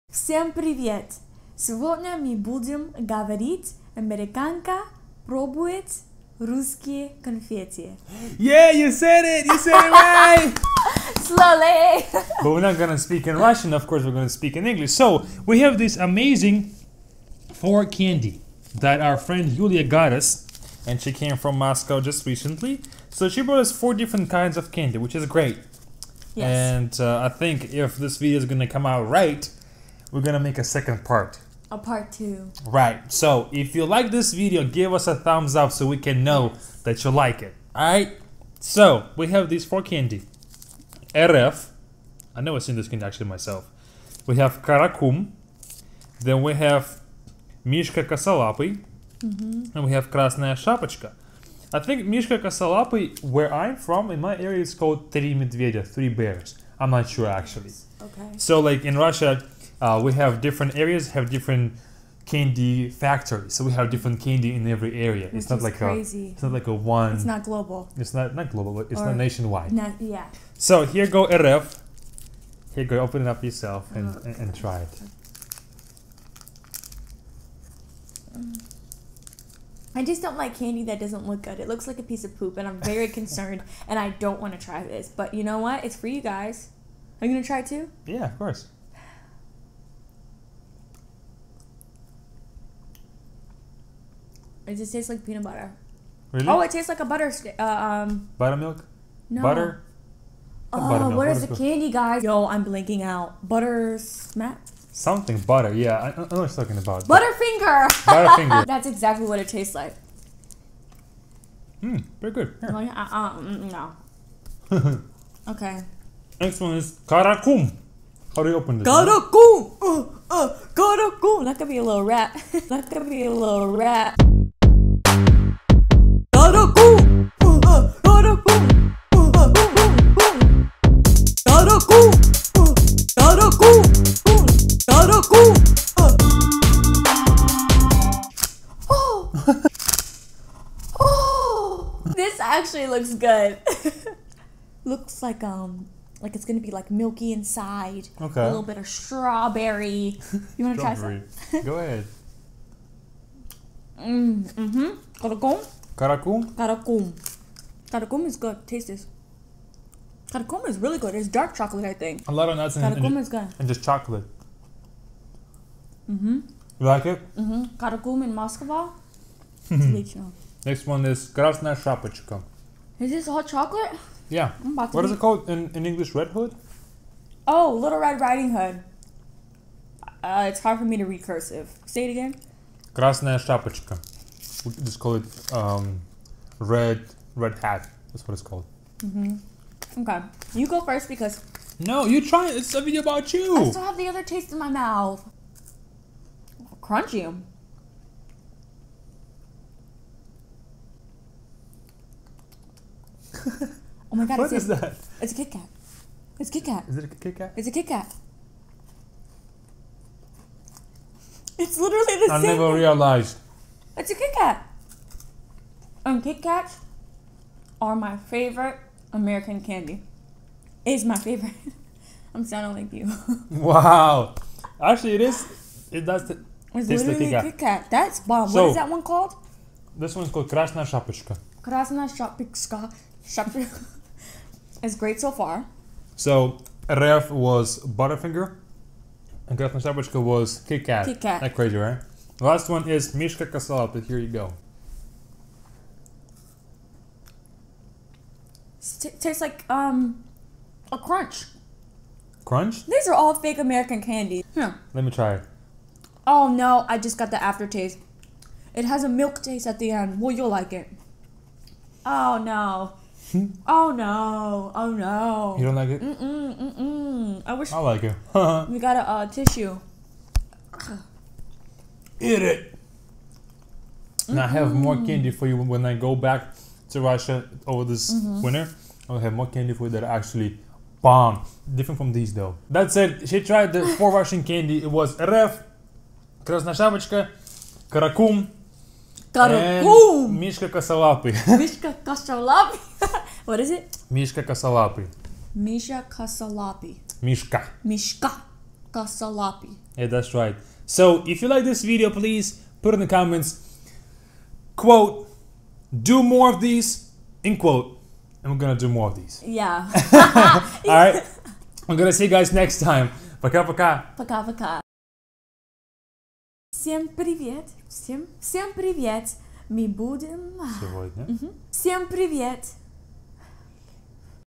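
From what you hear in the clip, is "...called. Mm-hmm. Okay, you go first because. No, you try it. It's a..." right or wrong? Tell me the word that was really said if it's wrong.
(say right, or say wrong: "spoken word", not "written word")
right.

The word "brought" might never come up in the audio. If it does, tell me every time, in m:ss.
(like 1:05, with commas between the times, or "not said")
0:23.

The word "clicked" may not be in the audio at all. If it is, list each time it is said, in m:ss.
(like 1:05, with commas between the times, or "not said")
not said.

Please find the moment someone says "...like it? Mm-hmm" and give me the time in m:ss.
2:46.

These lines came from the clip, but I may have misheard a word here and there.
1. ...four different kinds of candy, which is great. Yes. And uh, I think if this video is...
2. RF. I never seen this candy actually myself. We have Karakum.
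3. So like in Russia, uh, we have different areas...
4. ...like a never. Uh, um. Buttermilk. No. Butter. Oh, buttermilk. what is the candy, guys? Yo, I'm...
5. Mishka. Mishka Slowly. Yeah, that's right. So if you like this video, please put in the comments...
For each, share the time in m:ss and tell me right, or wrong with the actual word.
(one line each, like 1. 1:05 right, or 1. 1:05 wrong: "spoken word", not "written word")
1. 0:23 right
2. 0:41 right
3. 0:58 right
4. 1:36 wrong: "butter", not "never"
5. 4:57 wrong: "Kasalapi", not "Slowly".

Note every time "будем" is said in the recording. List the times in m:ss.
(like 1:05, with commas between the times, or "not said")
0:02, 5:19.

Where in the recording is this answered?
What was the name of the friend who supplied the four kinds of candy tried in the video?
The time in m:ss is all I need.
0:18.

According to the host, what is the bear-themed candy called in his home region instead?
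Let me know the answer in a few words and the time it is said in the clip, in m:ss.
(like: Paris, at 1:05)
Three bears, at 0:55.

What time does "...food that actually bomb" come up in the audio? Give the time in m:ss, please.
4:39.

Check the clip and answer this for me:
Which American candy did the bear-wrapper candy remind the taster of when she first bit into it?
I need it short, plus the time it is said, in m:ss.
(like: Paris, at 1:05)
Crunch, at 4:09.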